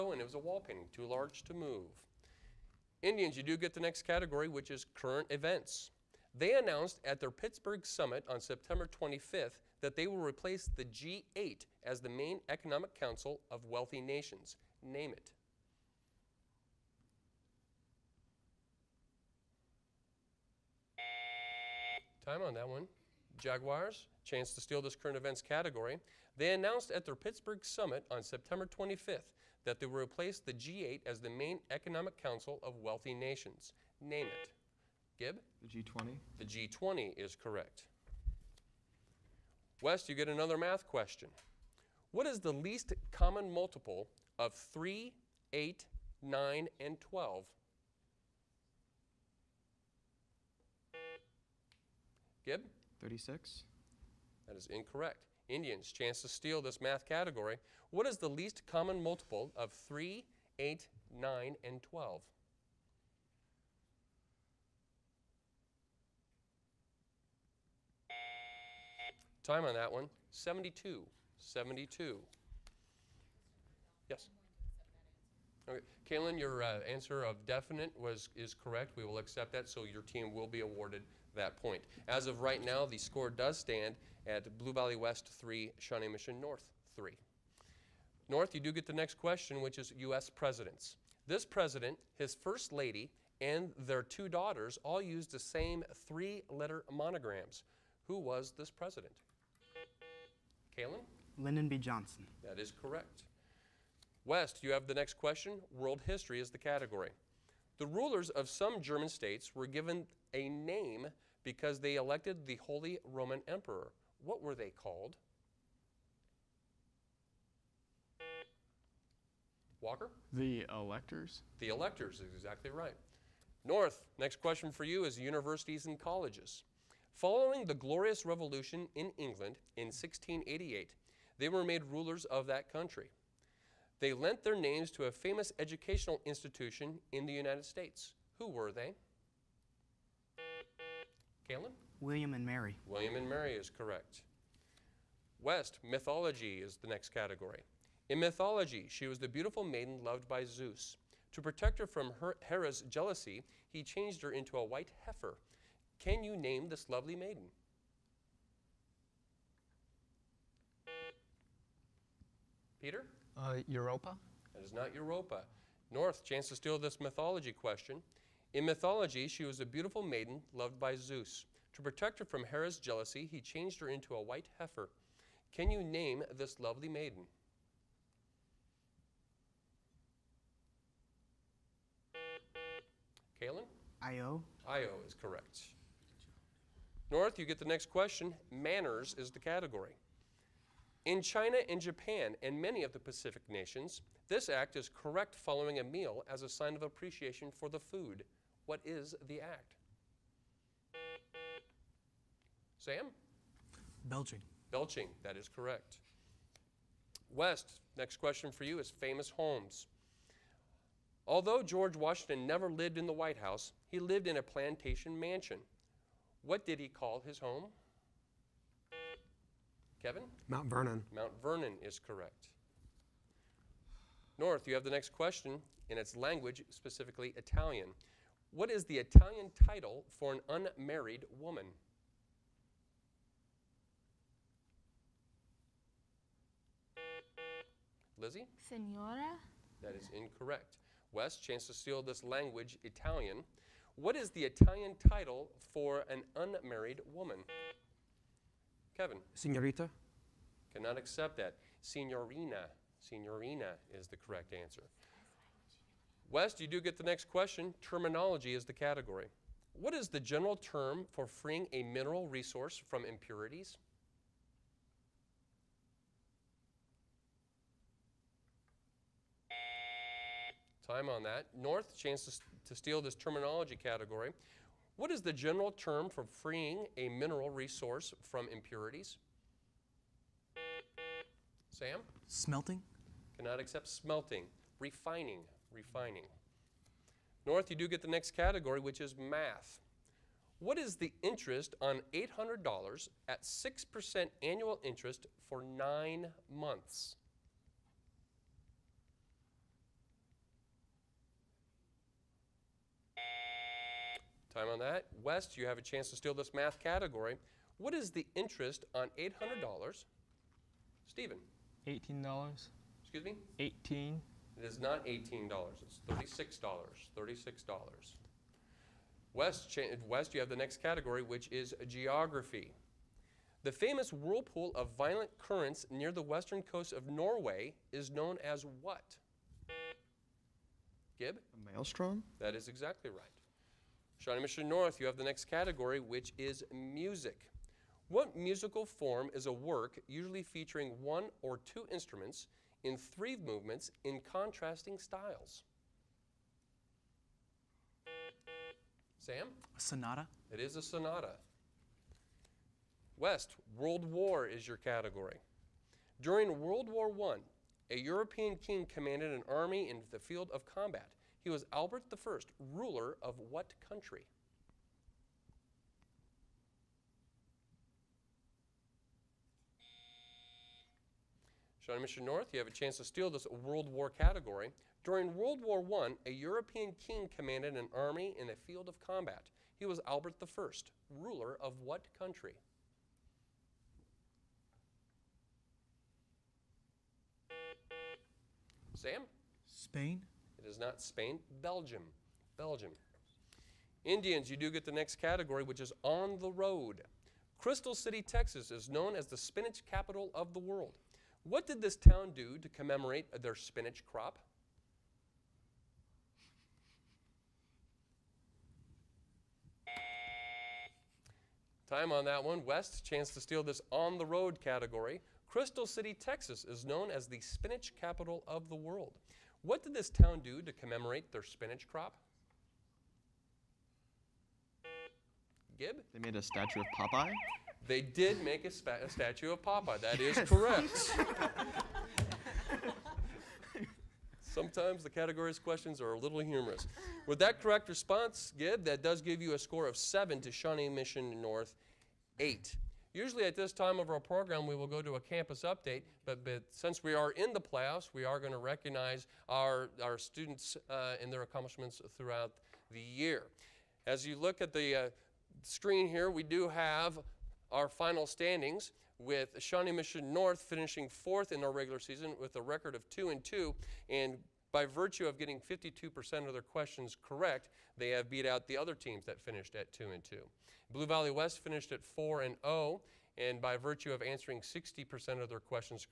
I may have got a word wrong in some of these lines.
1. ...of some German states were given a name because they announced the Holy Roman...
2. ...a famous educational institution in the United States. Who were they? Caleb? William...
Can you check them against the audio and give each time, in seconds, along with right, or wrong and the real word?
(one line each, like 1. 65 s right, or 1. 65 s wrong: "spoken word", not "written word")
1. 108 s wrong: "elected", not "announced"
2. 135 s right.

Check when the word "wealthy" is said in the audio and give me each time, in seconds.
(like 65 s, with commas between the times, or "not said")
13 s, 32 s.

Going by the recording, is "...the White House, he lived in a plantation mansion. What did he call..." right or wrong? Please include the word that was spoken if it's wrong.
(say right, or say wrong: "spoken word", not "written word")
right.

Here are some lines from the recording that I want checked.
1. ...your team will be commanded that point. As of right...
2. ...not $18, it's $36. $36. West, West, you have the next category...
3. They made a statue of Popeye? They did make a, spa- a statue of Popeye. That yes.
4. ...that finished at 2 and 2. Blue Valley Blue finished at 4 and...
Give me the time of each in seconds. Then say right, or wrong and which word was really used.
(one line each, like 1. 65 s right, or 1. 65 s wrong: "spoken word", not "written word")
1. 79 s wrong: "awarded", not "commanded"
2. 314 s right
3. 426 s right
4. 469 s wrong: "West", not "Blue".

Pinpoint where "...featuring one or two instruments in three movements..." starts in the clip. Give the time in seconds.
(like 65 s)
340 s.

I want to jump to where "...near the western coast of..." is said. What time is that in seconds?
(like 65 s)
325 s.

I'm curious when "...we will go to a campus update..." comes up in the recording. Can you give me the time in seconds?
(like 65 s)
444 s.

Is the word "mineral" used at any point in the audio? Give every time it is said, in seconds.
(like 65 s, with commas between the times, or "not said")
261 s, 277 s.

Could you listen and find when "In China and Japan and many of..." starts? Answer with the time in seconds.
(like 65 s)
191 s.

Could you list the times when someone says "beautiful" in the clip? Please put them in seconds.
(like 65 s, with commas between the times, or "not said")
149 s, 169 s.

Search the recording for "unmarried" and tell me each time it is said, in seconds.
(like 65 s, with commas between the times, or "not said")
230 s, 246 s.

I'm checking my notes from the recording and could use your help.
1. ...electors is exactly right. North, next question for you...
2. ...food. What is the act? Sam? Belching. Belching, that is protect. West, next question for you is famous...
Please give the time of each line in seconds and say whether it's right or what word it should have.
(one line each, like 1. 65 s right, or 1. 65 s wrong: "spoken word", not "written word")
1. 121 s right
2. 197 s wrong: "correct", not "protect".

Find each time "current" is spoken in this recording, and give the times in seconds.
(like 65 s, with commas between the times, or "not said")
4 s, 24 s, 325 s.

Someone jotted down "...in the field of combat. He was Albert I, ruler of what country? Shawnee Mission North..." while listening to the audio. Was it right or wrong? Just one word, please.
right.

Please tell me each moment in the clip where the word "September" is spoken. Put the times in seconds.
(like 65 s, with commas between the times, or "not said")
8 s, 28 s.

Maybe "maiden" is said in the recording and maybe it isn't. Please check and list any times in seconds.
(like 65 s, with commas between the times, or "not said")
149 s, 157 s, 170 s, 176 s.